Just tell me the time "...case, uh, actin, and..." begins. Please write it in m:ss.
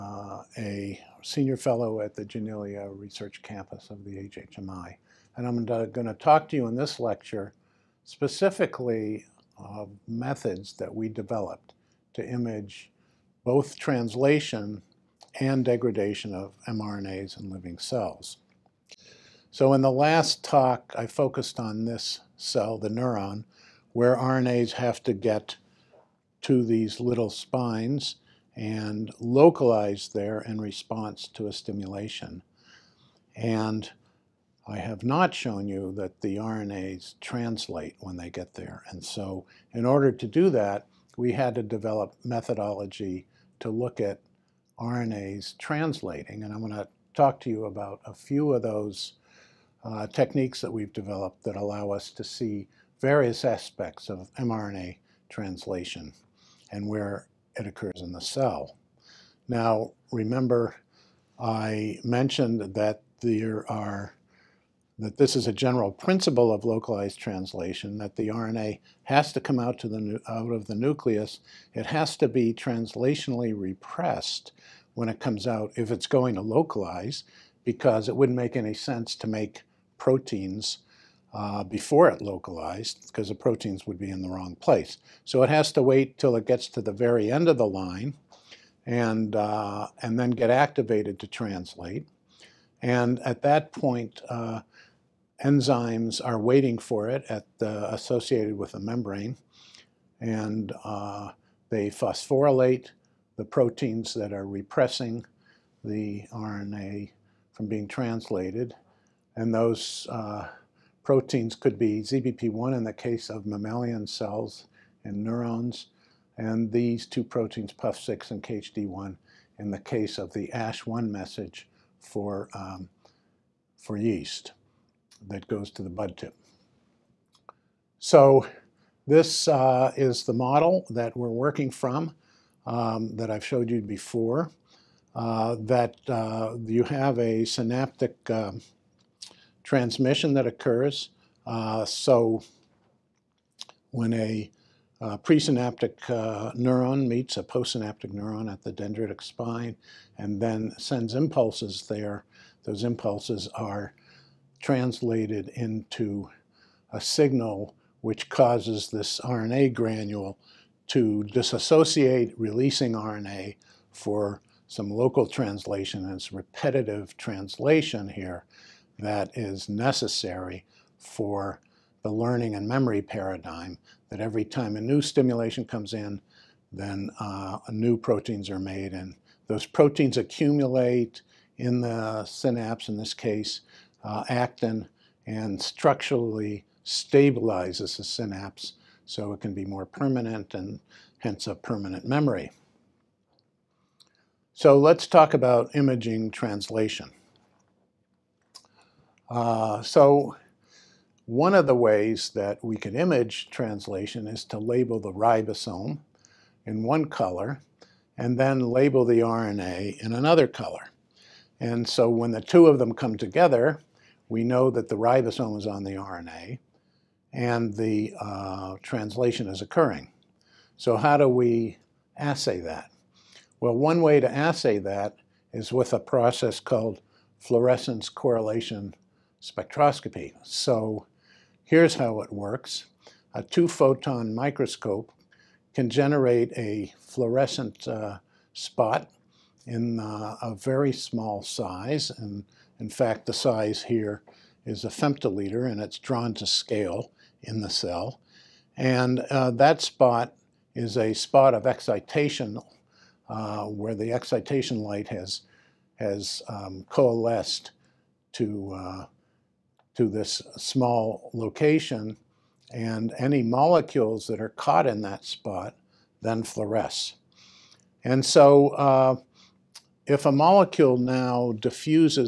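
3:03.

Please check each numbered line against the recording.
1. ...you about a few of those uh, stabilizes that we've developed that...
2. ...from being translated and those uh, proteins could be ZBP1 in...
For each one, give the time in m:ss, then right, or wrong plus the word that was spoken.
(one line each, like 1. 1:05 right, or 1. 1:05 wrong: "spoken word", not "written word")
1. 0:47 wrong: "techniques", not "stabilizes"
2. 1:47 right.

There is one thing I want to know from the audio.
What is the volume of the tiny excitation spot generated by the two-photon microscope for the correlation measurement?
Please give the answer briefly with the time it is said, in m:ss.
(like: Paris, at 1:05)
a femtoliter, at 4:04.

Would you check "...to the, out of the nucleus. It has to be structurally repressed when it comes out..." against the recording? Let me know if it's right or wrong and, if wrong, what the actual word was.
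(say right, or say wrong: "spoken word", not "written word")
wrong: "translationally", not "structurally".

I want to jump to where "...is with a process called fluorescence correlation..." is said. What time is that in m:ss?
3:45.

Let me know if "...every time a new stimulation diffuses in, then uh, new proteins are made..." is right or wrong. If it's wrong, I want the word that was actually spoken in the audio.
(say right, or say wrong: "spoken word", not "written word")
wrong: "comes", not "diffuses".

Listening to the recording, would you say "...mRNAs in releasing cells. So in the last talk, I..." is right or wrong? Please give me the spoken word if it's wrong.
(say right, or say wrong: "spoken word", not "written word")
wrong: "living", not "releasing".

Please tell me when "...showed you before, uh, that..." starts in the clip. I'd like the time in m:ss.
2:13.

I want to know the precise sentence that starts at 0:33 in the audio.
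And I have not shown you that the RNAs translate when they get there.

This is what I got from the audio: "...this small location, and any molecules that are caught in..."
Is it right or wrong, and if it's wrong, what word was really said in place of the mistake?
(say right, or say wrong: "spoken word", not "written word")
right.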